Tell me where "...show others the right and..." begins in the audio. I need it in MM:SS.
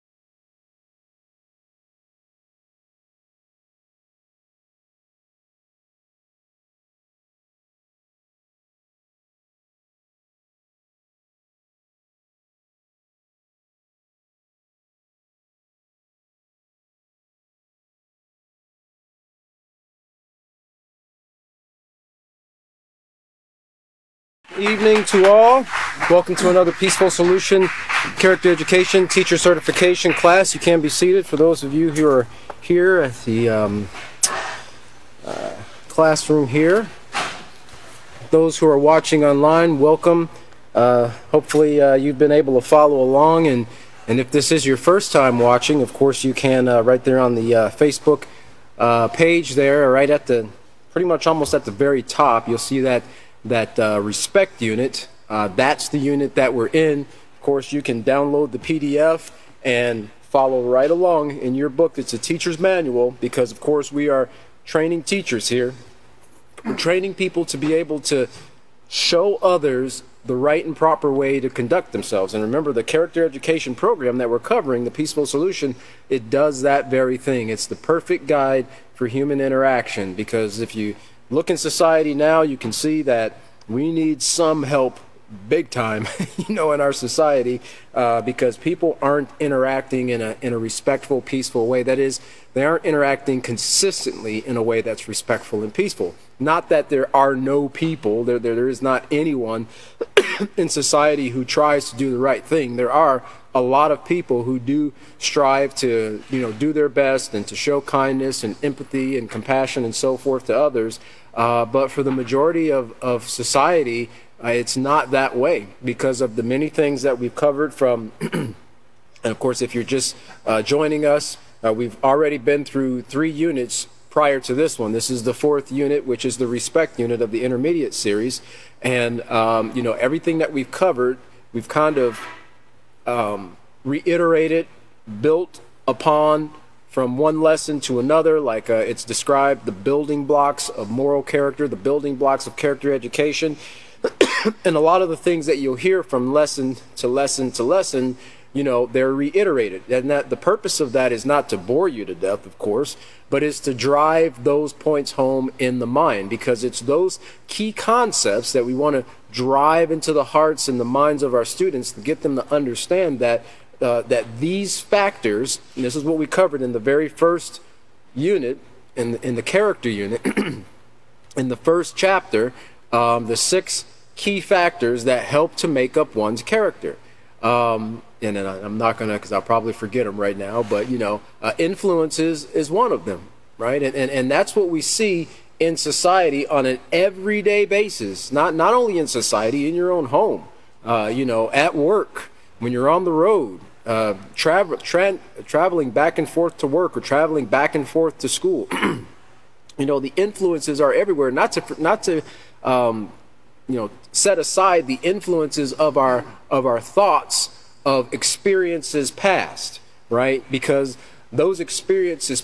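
01:08.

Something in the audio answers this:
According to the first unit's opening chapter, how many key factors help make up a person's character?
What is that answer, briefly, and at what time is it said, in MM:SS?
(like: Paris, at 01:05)
6, at 02:53.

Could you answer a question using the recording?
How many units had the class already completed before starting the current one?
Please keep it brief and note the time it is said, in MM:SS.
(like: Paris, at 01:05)
3, at 02:03.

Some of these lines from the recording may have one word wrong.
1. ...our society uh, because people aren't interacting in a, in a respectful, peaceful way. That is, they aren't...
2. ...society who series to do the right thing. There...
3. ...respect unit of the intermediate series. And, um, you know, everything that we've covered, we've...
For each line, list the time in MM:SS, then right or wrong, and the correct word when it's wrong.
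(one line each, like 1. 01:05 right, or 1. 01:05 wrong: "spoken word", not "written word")
1. 01:26 right
2. 01:40 wrong: "tries", not "series"
3. 02:06 right.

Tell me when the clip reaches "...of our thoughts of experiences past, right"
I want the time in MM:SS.
03:26.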